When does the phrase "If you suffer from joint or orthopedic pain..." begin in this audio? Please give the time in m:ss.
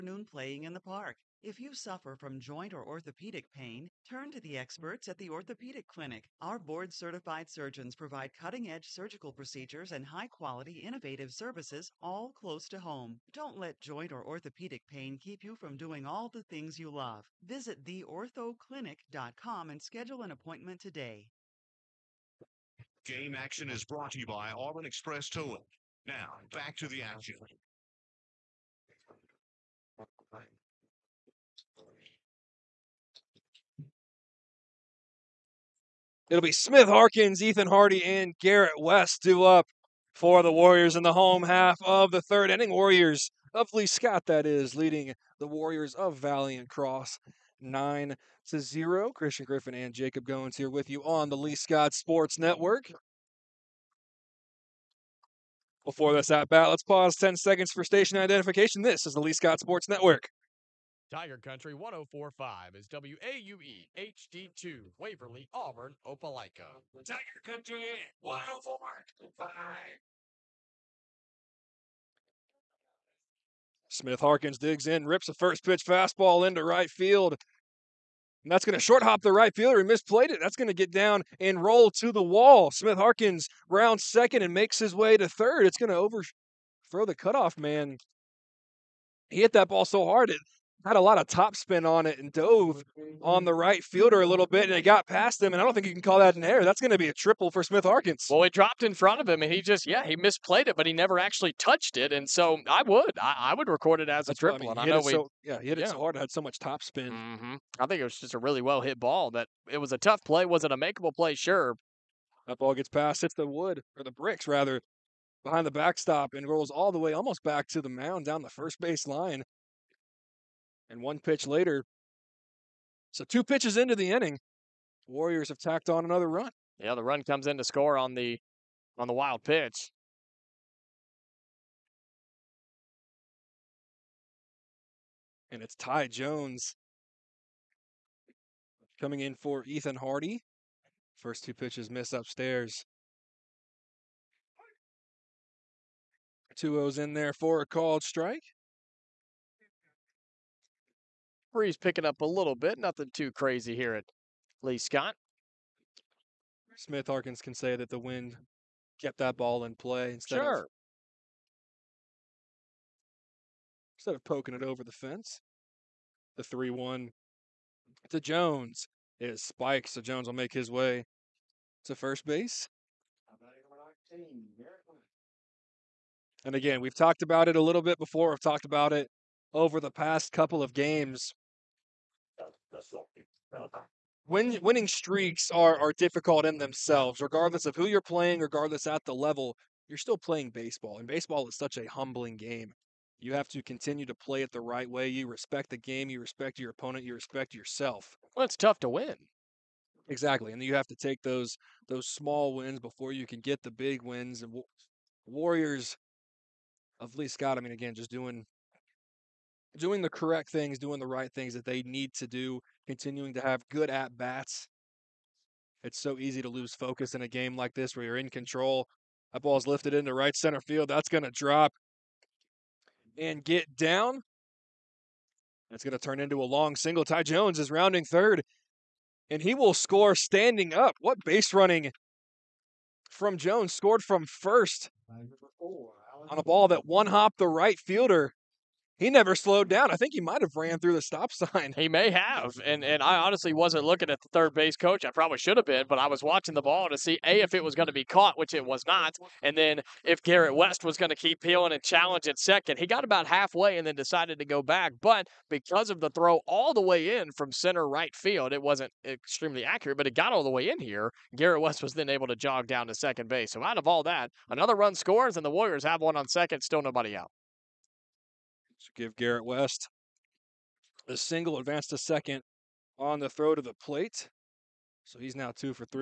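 0:01.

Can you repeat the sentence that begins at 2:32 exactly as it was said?
Nothing too crazy here at Lee Scott.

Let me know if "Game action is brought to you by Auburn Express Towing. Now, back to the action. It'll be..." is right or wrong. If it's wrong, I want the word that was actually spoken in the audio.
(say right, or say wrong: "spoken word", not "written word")
right.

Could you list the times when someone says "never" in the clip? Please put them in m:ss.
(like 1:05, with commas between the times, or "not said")
1:40, 3:59.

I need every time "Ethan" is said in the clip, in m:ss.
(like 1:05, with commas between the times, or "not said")
0:37, 2:19.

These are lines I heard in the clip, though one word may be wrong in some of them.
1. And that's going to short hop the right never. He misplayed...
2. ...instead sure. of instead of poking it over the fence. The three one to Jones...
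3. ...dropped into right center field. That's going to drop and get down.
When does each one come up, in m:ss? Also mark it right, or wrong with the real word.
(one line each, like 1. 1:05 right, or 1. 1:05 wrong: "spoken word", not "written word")
1. 1:18 wrong: "fielder", not "never"
2. 2:40 right
3. 3:39 wrong: "lifted", not "dropped".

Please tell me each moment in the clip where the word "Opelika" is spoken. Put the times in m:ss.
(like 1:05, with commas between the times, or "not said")
1:06.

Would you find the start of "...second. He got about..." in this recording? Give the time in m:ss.
4:12.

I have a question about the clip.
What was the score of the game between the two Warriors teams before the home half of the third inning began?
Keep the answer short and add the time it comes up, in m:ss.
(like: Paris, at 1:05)
9 to 0, at 0:47.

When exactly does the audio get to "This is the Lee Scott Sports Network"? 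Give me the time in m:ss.
0:58.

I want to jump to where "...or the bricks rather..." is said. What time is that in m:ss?
1:53.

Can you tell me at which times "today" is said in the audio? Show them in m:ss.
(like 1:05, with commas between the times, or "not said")
0:20.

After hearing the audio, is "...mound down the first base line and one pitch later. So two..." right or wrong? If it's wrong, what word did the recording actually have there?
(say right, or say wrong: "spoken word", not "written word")
right.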